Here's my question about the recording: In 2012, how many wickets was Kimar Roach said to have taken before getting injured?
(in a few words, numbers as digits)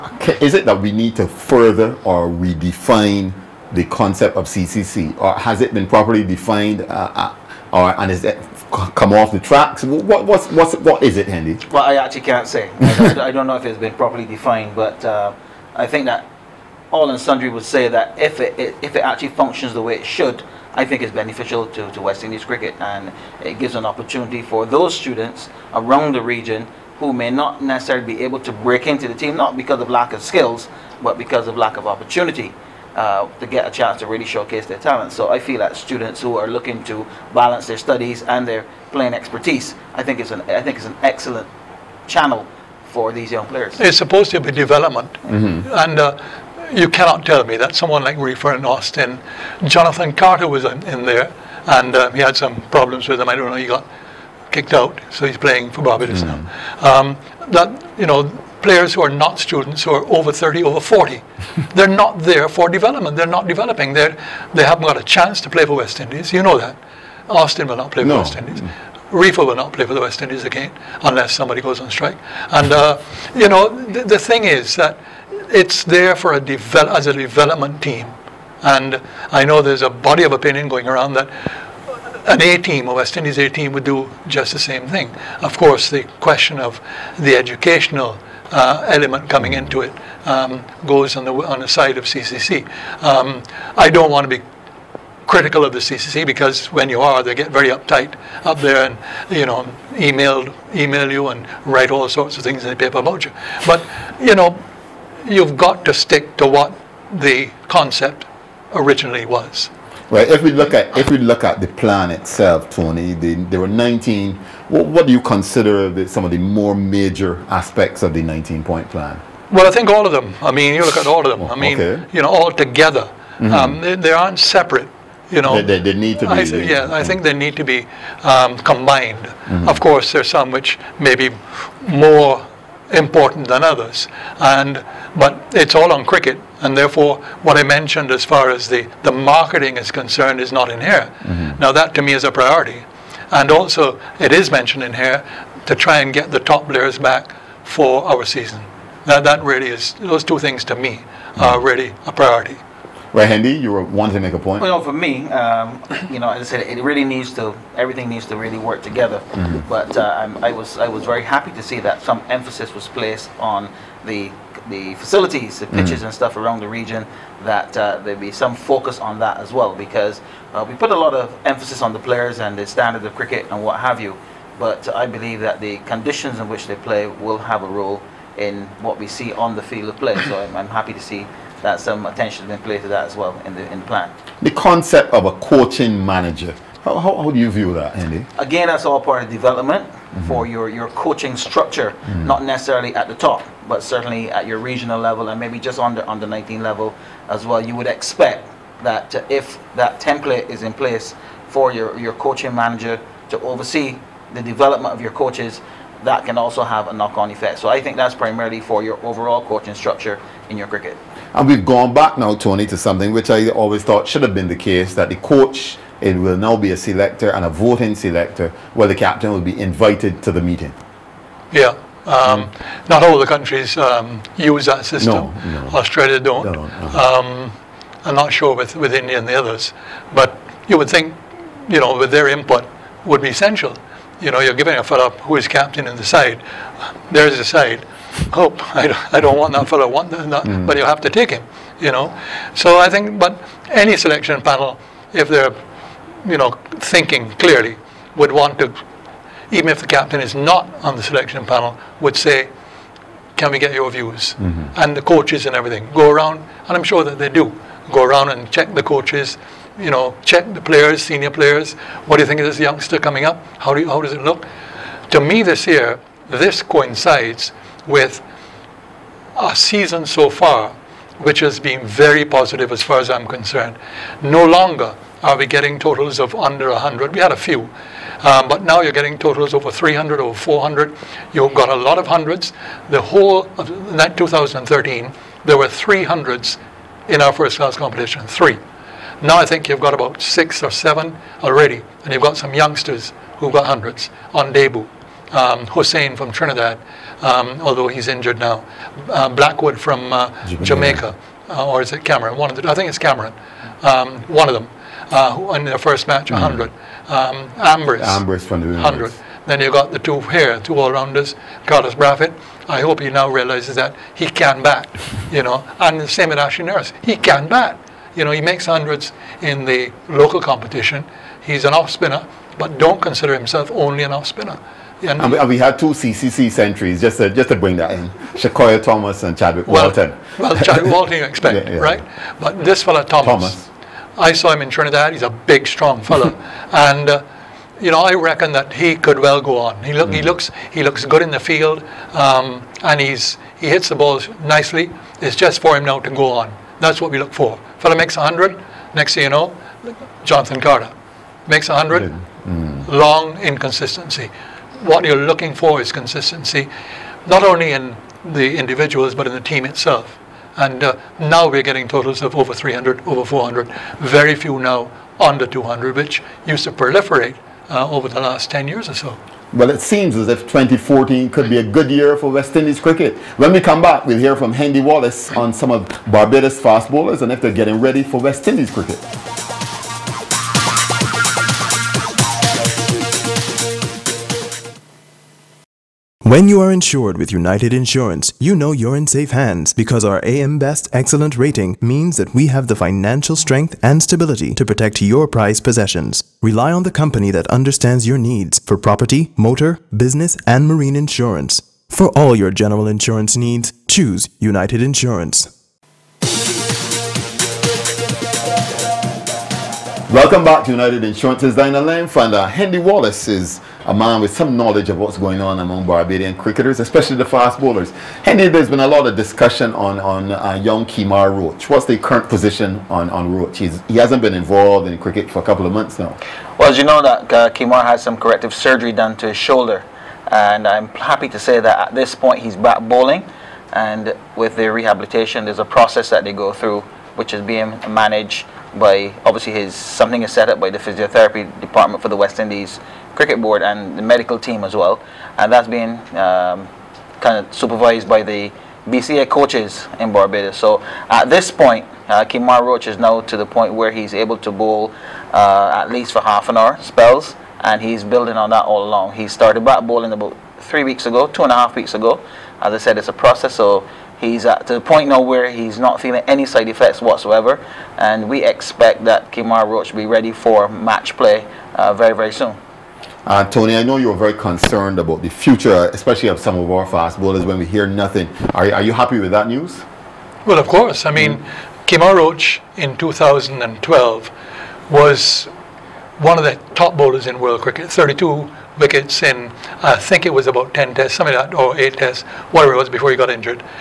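32.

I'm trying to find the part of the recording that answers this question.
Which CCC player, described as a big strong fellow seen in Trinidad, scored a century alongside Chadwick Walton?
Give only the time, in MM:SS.
05:28.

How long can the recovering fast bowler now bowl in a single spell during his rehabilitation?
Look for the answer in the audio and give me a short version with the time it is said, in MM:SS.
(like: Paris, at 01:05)
half an hour, at 07:36.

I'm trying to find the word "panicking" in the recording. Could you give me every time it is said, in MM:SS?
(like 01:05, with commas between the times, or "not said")
not said.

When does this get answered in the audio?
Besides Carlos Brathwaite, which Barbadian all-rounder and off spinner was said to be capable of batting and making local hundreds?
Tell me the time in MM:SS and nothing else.
05:16.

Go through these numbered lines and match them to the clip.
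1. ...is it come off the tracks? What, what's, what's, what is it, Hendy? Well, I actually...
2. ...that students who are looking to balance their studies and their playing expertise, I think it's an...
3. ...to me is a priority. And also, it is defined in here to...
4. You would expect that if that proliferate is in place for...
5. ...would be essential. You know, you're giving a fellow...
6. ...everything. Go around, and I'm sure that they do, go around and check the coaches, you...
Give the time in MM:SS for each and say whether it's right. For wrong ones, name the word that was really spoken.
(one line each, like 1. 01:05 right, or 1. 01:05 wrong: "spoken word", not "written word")
1. 00:08 right
2. 00:35 right
3. 02:21 wrong: "mentioned", not "defined"
4. 03:17 wrong: "template", not "proliferate"
5. 03:53 right
6. 04:15 right.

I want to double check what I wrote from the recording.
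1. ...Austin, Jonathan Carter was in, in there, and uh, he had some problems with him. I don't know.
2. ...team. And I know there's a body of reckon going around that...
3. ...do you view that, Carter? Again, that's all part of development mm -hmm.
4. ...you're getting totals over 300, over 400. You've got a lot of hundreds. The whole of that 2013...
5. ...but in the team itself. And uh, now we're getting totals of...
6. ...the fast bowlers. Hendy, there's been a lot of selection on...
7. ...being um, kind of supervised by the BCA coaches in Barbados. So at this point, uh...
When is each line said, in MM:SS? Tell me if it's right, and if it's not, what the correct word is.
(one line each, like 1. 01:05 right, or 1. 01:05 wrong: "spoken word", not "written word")
1. 00:48 right
2. 01:17 wrong: "opinion", not "reckon"
3. 03:07 wrong: "Hendy", not "Carter"
4. 04:38 right
5. 05:59 right
6. 06:57 wrong: "discussion", not "selection"
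7. 07:25 right.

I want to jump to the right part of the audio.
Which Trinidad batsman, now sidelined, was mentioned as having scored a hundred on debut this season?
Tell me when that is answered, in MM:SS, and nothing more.
04:55.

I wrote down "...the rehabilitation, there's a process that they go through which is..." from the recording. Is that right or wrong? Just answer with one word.
right.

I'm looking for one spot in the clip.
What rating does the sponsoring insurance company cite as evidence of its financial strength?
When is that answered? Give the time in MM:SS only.
06:30.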